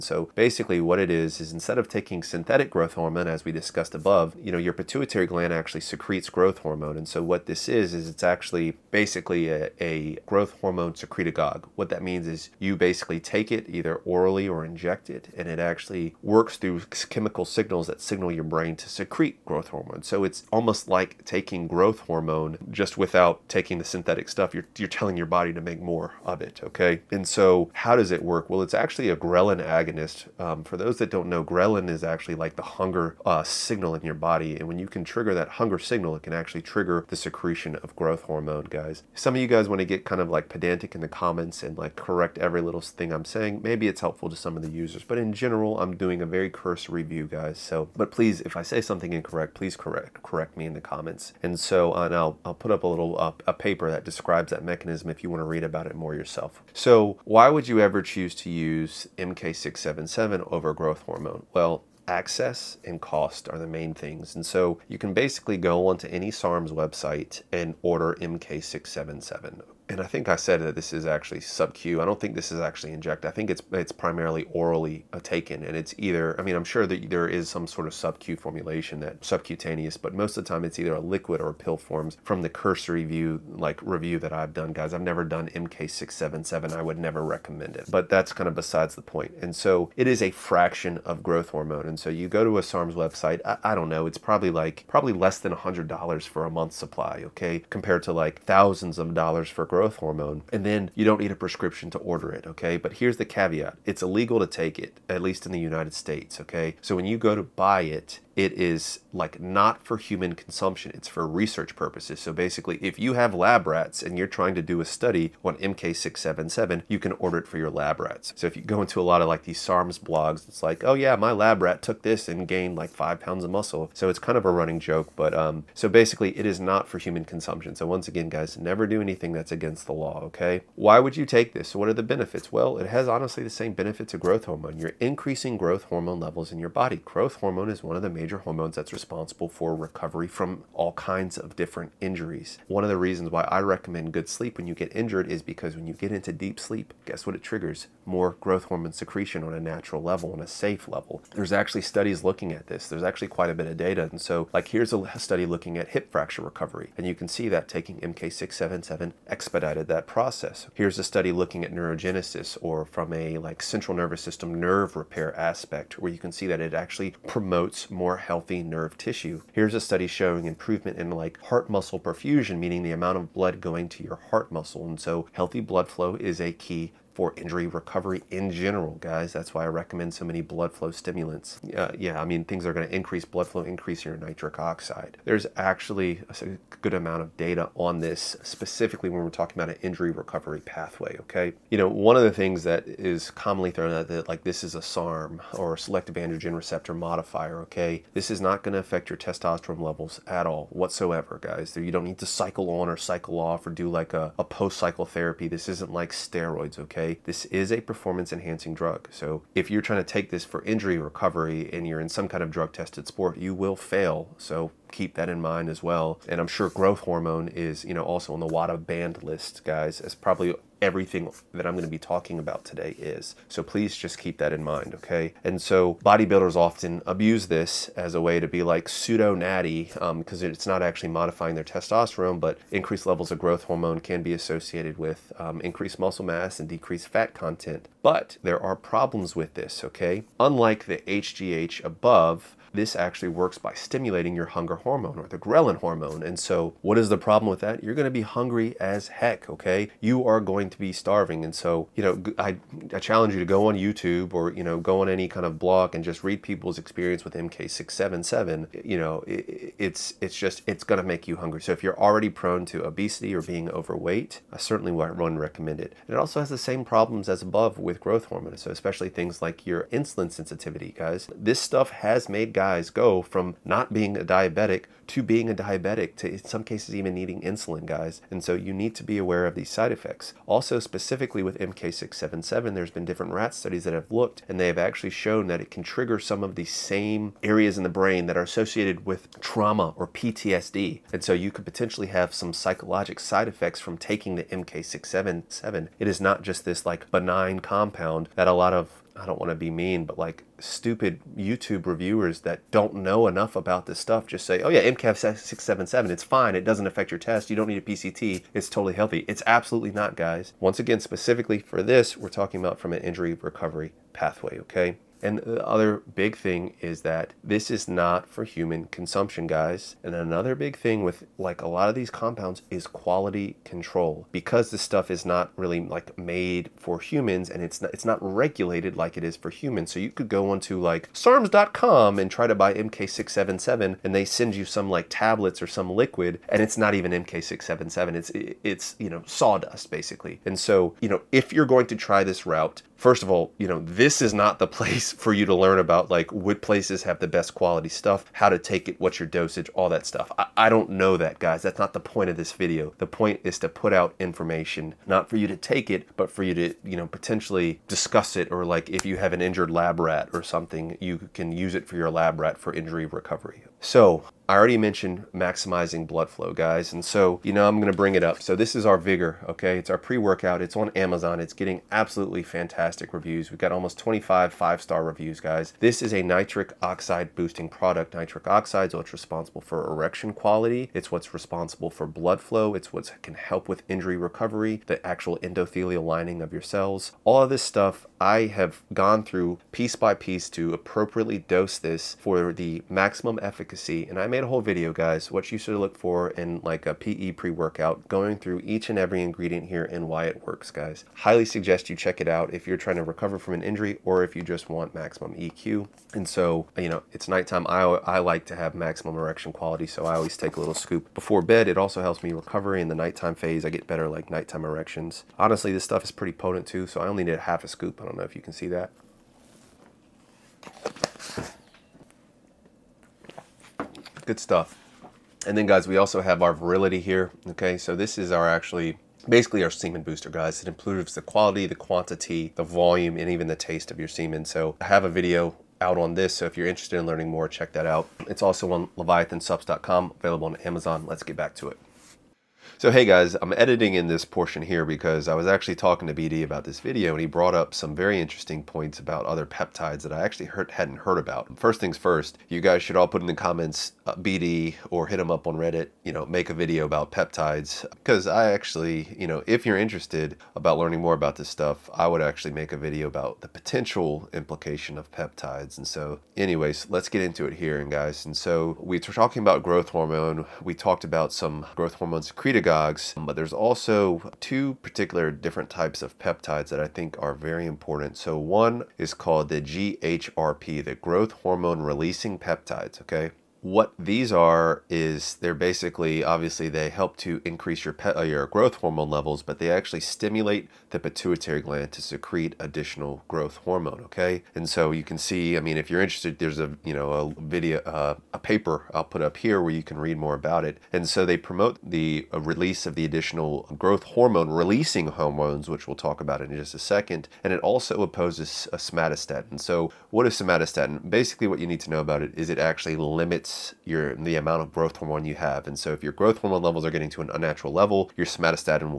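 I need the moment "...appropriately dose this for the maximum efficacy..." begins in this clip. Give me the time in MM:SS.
06:30.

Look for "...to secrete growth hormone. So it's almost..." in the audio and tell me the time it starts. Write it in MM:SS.
00:18.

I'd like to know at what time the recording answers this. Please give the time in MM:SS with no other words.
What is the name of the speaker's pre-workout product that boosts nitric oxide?
06:08.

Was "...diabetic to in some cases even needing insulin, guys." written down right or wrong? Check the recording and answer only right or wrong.
right.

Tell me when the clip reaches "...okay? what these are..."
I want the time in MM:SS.
08:03.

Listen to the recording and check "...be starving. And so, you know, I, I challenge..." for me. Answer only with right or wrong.
right.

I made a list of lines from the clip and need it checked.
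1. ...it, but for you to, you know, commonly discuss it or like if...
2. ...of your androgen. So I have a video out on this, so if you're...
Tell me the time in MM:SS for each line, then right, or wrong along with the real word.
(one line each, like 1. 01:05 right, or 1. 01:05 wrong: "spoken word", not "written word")
1. 05:55 wrong: "potentially", not "commonly"
2. 07:13 wrong: "semen", not "androgen".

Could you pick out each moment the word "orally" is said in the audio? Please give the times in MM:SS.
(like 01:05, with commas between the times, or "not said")
00:14, 01:14.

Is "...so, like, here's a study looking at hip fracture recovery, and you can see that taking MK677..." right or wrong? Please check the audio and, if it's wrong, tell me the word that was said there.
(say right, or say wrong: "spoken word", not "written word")
right.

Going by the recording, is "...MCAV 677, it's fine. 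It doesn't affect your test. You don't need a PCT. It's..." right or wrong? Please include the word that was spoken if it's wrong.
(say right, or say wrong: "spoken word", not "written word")
right.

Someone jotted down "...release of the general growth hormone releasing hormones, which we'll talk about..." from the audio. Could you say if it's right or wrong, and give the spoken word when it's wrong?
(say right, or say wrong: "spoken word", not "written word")
wrong: "additional", not "general".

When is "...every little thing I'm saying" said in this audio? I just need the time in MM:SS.
00:42.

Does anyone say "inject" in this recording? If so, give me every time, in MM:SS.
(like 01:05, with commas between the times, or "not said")
00:14, 01:12.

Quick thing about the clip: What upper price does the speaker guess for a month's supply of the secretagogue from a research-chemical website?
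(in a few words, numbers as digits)
less than $100.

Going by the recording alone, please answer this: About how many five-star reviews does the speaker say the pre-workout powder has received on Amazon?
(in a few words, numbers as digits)
25.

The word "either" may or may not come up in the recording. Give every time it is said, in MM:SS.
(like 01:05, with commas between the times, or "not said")
00:13, 01:15, 01:20.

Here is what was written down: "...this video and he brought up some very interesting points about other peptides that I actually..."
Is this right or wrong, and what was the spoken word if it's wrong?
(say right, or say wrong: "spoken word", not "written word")
right.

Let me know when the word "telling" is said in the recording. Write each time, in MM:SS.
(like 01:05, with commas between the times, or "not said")
00:24.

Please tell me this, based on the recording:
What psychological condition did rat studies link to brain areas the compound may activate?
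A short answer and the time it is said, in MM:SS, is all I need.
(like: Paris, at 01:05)
PTSD, at 04:50.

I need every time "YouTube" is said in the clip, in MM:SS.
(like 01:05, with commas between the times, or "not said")
04:13, 05:01.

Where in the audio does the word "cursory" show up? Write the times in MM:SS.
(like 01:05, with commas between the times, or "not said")
00:46, 01:22.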